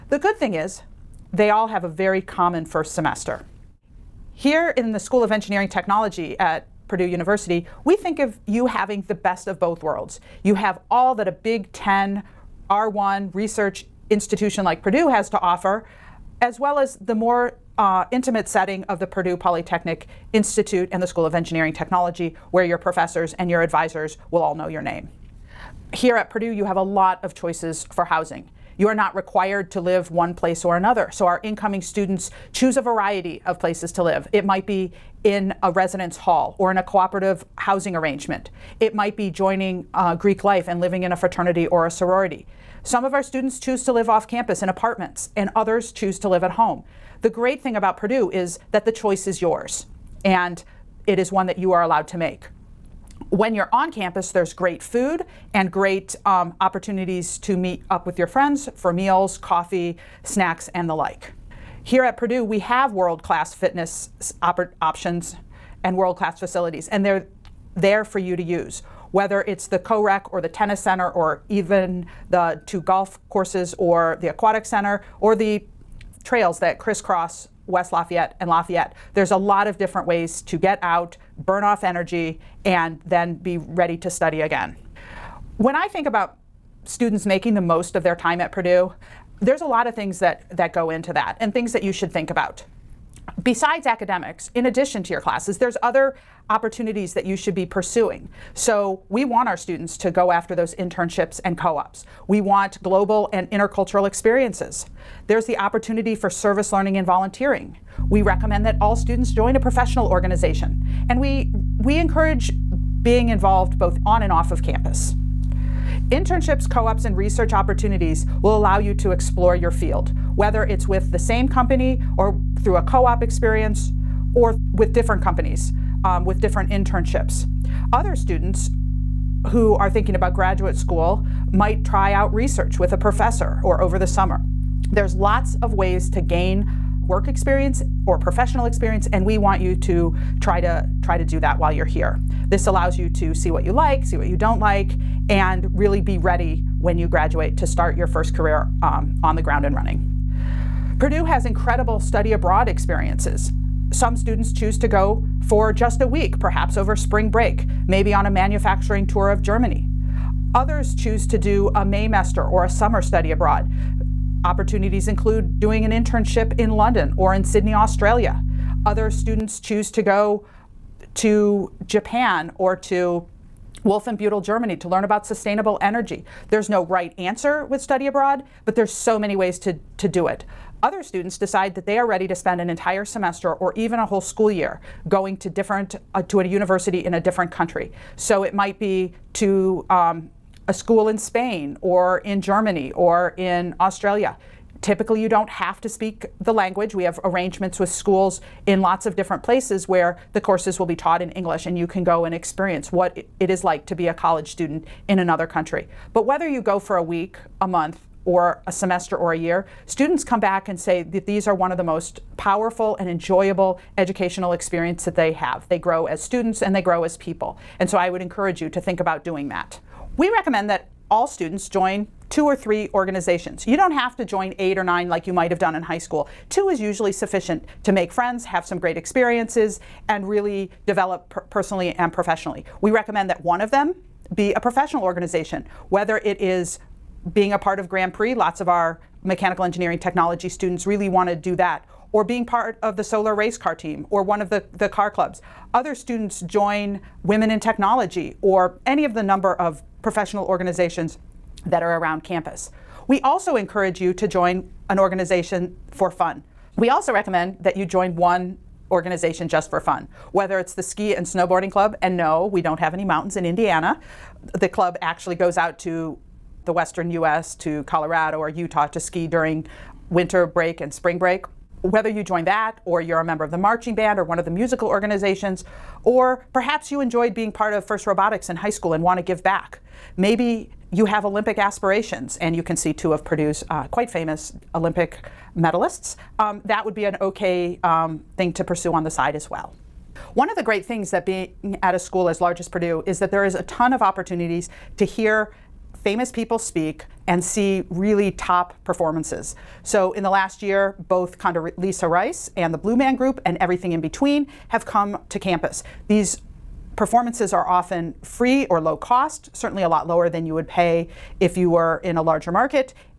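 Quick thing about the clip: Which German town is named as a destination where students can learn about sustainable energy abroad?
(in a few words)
Wolfenbüttel.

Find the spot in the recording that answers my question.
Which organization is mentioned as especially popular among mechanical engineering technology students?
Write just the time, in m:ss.
3:57.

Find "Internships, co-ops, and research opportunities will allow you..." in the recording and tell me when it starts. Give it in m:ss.
1:56.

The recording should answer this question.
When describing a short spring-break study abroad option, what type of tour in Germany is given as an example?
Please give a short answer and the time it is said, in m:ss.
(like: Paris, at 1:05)
Manufacturing tour, at 2:38.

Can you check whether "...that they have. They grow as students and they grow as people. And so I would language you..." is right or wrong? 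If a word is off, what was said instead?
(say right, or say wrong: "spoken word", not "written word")
wrong: "encourage", not "language".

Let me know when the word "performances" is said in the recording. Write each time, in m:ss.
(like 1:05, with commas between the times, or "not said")
4:58, 5:06.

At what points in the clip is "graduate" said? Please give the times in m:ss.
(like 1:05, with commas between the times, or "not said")
2:10, 2:27.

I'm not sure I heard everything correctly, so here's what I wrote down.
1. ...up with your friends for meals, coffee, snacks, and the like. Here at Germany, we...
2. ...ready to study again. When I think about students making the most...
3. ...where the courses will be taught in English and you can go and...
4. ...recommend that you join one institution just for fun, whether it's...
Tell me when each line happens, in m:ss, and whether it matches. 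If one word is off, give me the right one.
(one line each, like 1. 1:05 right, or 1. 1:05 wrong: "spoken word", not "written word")
1. 0:57 wrong: "Purdue", not "Germany"
2. 1:23 right
3. 3:19 right
4. 4:17 wrong: "organization", not "institution".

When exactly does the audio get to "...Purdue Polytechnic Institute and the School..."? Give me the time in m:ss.
0:19.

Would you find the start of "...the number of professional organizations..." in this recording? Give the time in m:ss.
4:09.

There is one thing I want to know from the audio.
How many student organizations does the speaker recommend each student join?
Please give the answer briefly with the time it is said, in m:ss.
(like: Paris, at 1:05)
2 or 3, at 3:42.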